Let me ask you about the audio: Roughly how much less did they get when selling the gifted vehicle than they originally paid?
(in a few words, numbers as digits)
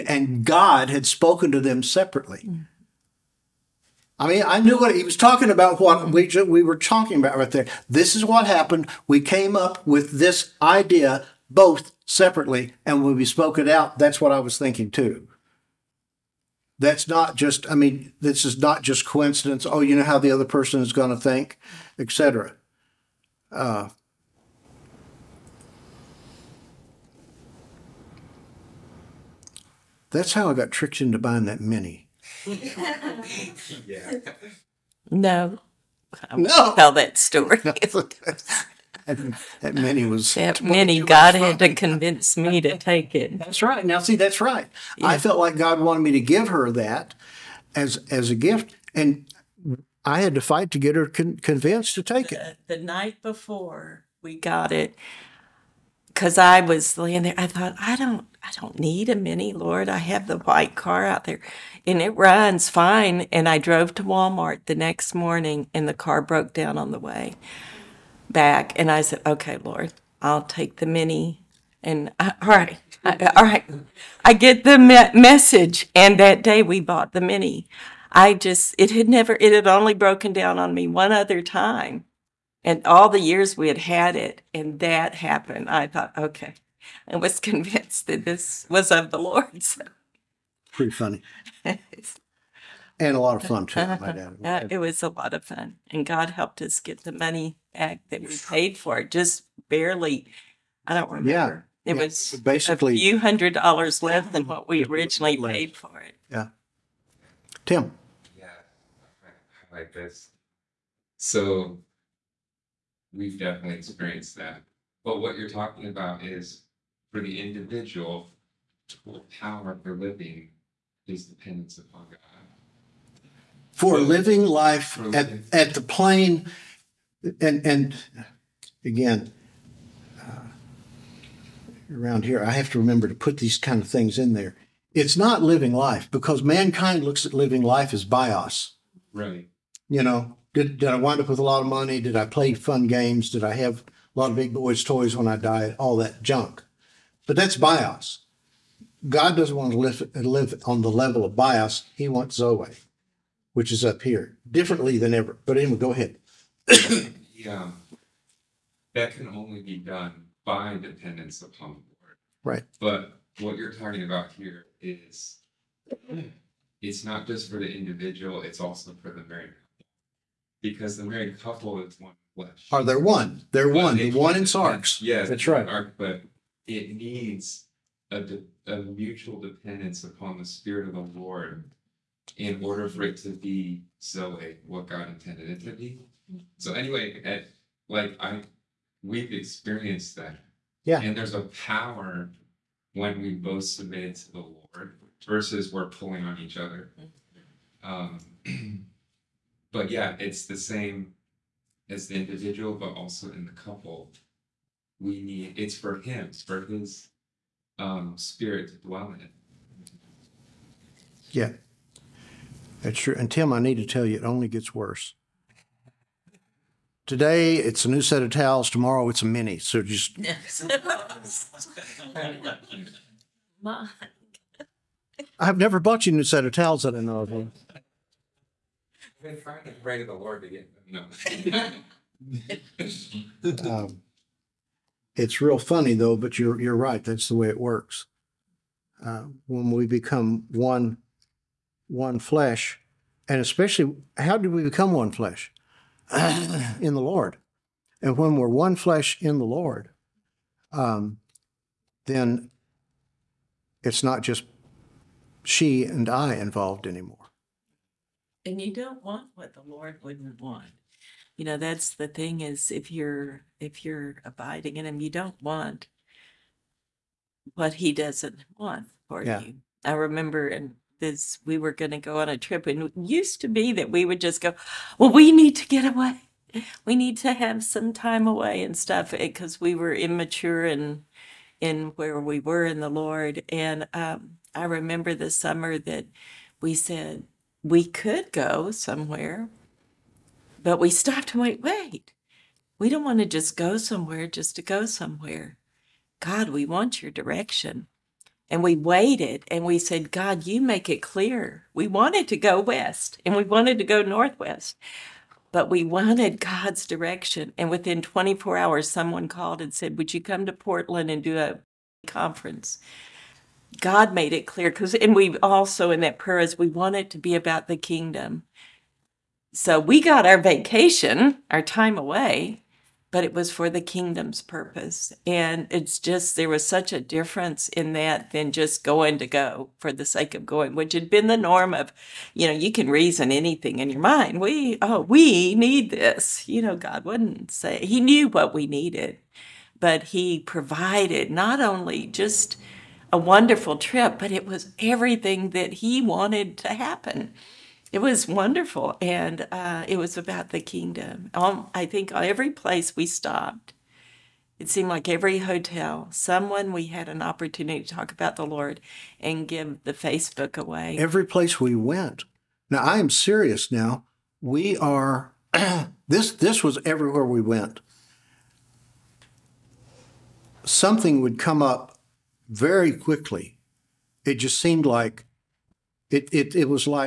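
A few hundred dollars.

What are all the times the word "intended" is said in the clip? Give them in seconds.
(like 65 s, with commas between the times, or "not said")
185 s.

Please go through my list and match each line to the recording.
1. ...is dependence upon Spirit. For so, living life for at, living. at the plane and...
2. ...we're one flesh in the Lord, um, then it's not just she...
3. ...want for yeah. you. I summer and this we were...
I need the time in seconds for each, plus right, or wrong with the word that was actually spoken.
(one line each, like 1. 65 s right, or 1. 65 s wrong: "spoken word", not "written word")
1. 121 s wrong: "God", not "Spirit"
2. 248 s right
3. 268 s wrong: "remember", not "summer".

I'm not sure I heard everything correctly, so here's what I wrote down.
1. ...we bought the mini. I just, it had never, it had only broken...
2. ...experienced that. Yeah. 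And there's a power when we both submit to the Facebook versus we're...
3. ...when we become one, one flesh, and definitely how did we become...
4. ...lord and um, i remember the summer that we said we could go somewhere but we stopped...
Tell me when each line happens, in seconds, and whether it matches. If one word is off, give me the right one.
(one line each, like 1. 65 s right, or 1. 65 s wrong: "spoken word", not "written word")
1. 76 s right
2. 189 s wrong: "Lord", not "Facebook"
3. 239 s wrong: "especially", not "definitely"
4. 282 s right.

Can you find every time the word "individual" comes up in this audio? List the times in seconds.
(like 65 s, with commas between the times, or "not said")
117 s, 167 s, 202 s.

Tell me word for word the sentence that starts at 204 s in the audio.
We need it's for him, it's for his um, spirit to dwell in.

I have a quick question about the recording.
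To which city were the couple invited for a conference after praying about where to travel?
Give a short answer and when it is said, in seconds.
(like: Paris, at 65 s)
Portland, at 310 s.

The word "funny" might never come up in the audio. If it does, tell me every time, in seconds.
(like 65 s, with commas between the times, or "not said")
90 s, 235 s.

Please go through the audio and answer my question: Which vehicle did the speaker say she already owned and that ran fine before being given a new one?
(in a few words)
The white car.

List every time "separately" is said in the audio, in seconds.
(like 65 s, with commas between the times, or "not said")
1 s, 12 s.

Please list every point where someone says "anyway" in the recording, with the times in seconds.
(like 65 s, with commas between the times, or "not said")
155 s, 186 s.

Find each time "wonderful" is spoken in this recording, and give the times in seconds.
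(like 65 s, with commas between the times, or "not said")
343 s, 348 s.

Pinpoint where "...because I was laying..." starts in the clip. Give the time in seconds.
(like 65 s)
56 s.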